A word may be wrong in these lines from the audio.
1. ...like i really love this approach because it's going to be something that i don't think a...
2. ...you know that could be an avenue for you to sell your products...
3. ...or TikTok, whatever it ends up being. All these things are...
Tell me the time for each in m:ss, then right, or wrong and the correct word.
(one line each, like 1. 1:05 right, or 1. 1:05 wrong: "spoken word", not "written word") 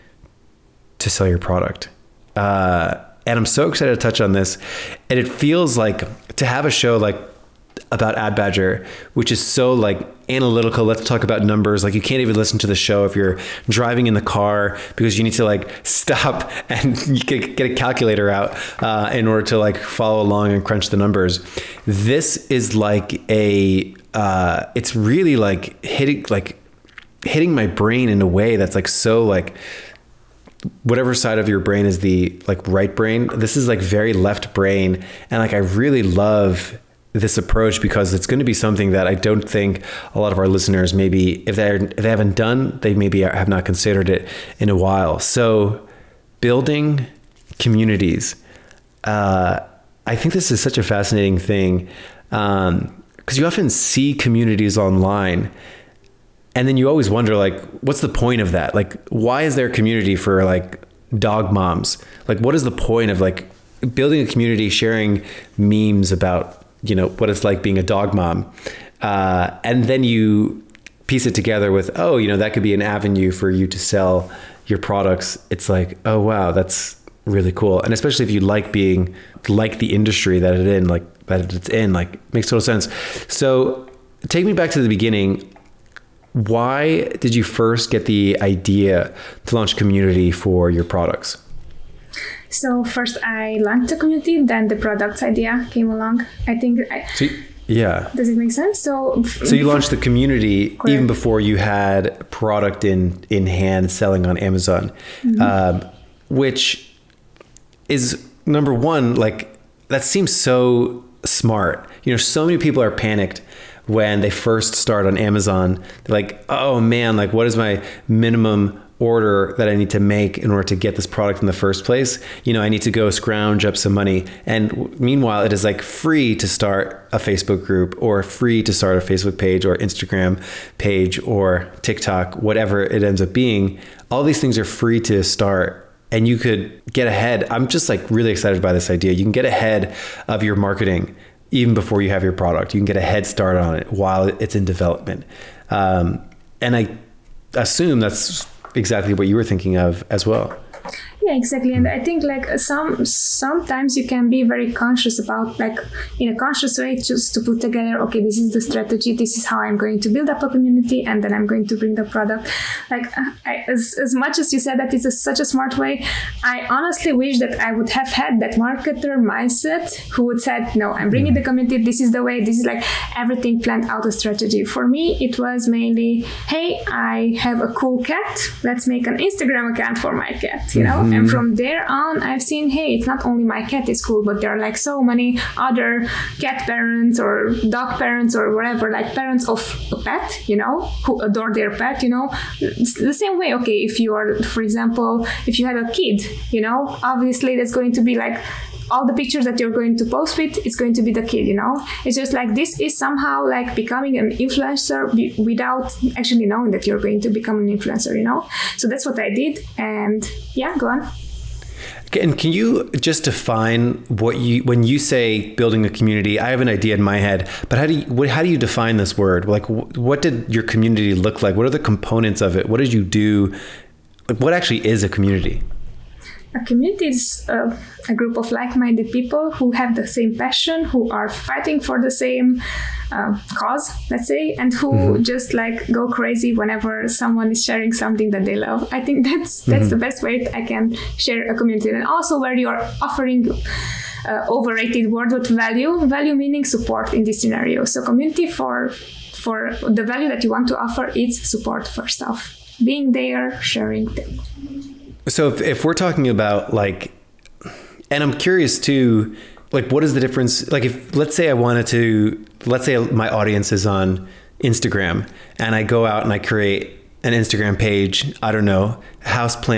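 1. 0:35 right
2. 1:12 right
3. 2:11 right.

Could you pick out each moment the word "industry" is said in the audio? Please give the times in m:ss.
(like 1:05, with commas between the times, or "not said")
1:19.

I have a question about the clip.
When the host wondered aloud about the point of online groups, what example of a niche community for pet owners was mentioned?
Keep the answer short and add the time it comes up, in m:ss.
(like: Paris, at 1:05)
dog moms, at 1:01.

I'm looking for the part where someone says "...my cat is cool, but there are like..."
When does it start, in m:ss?
3:03.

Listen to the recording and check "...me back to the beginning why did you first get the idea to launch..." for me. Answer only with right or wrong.
right.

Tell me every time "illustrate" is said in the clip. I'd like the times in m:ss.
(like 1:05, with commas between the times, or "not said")
not said.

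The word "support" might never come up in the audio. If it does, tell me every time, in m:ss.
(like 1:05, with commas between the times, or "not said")
4:06, 4:11.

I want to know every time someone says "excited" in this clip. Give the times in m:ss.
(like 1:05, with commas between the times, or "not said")
0:03, 2:18.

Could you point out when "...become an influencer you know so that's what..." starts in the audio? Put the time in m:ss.
3:27.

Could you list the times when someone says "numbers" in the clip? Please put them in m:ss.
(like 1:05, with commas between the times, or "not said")
0:11, 0:20, 1:48.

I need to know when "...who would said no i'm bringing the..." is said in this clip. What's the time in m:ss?
2:50.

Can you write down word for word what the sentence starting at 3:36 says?
I have an idea in my head, but how do you what, how do you define this word?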